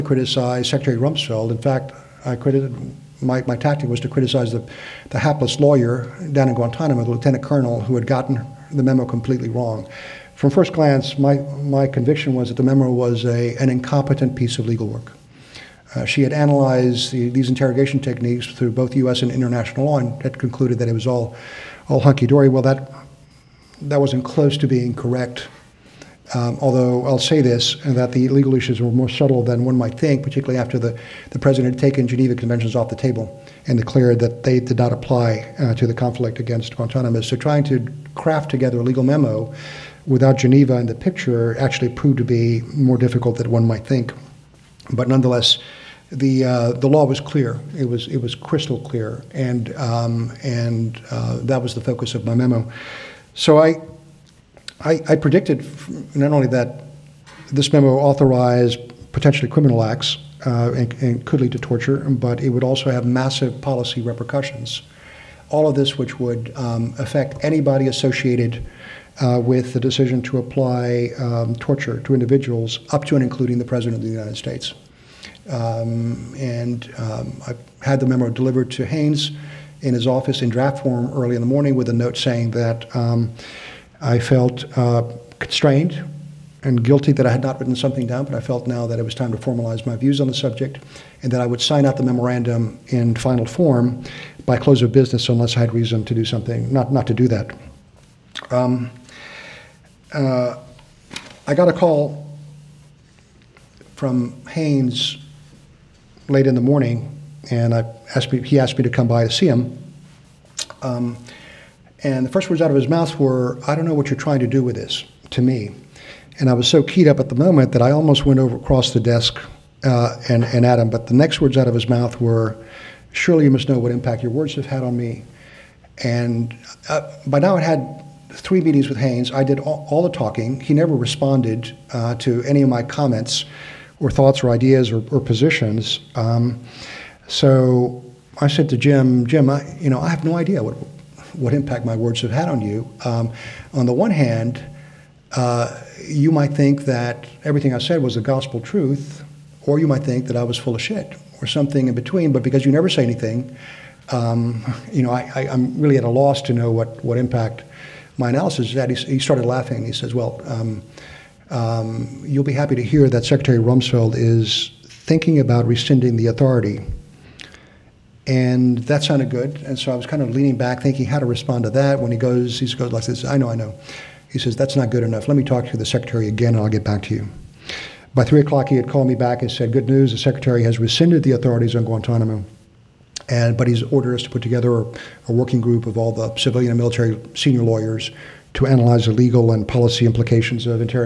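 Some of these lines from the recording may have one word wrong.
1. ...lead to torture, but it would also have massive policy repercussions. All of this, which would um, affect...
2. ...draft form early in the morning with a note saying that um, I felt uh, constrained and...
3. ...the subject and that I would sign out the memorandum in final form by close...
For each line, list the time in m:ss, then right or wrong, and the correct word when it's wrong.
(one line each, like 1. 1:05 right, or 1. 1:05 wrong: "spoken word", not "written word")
1. 1:01 right
2. 1:20 right
3. 1:30 right.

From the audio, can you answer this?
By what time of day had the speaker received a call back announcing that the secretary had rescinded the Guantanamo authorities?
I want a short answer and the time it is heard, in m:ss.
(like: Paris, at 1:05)
3 o'clock, at 2:58.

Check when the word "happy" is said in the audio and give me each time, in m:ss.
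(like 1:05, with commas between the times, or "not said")
2:42.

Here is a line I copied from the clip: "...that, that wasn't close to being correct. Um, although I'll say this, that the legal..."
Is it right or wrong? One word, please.
right.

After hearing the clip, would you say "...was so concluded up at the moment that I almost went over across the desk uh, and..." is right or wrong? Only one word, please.
wrong.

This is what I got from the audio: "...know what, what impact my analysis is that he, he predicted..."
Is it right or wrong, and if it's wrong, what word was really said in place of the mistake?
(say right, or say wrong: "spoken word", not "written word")
wrong: "started", not "predicted".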